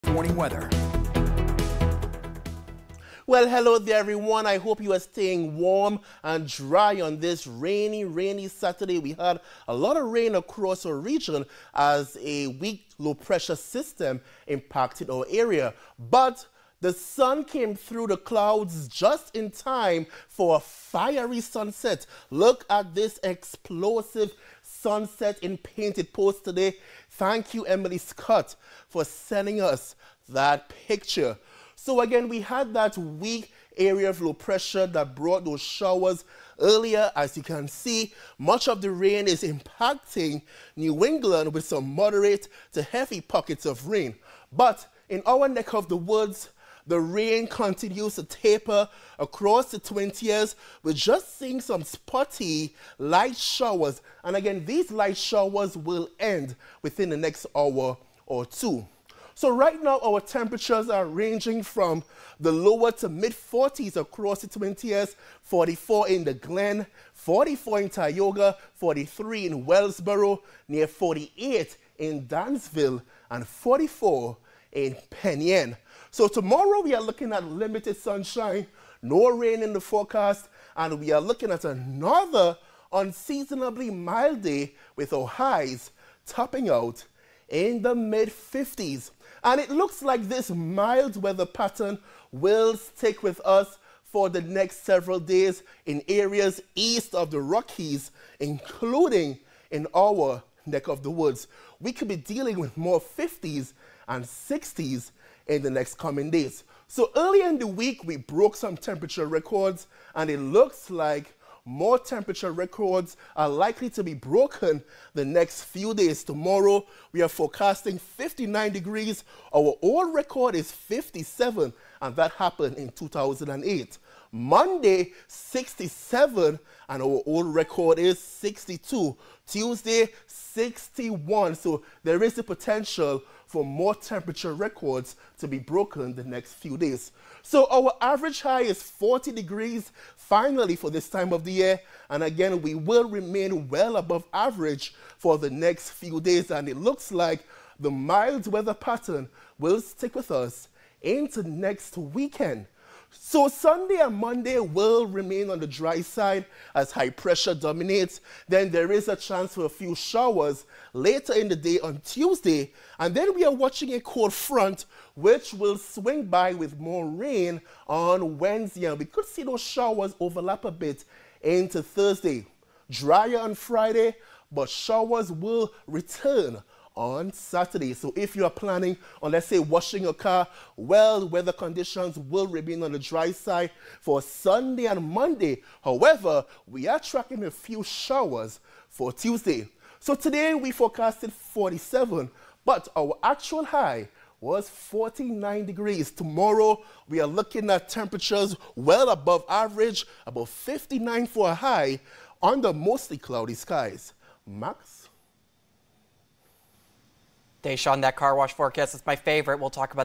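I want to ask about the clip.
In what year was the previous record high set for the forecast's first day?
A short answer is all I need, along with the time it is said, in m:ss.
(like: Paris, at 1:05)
2008, at 2:02.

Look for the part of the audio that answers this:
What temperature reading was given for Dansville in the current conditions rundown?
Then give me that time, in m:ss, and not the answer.
1:10.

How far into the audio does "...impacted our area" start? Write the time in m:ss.
0:14.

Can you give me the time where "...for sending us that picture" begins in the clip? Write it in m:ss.
0:28.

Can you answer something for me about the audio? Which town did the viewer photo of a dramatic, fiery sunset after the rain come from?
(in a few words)
Painted Post.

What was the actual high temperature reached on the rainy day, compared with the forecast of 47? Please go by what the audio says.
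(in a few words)
49 degrees.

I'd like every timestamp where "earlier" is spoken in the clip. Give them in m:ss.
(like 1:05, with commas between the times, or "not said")
0:36, 1:47.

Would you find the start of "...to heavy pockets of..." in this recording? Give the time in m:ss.
0:42.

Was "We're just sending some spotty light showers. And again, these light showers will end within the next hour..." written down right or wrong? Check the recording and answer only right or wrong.
wrong.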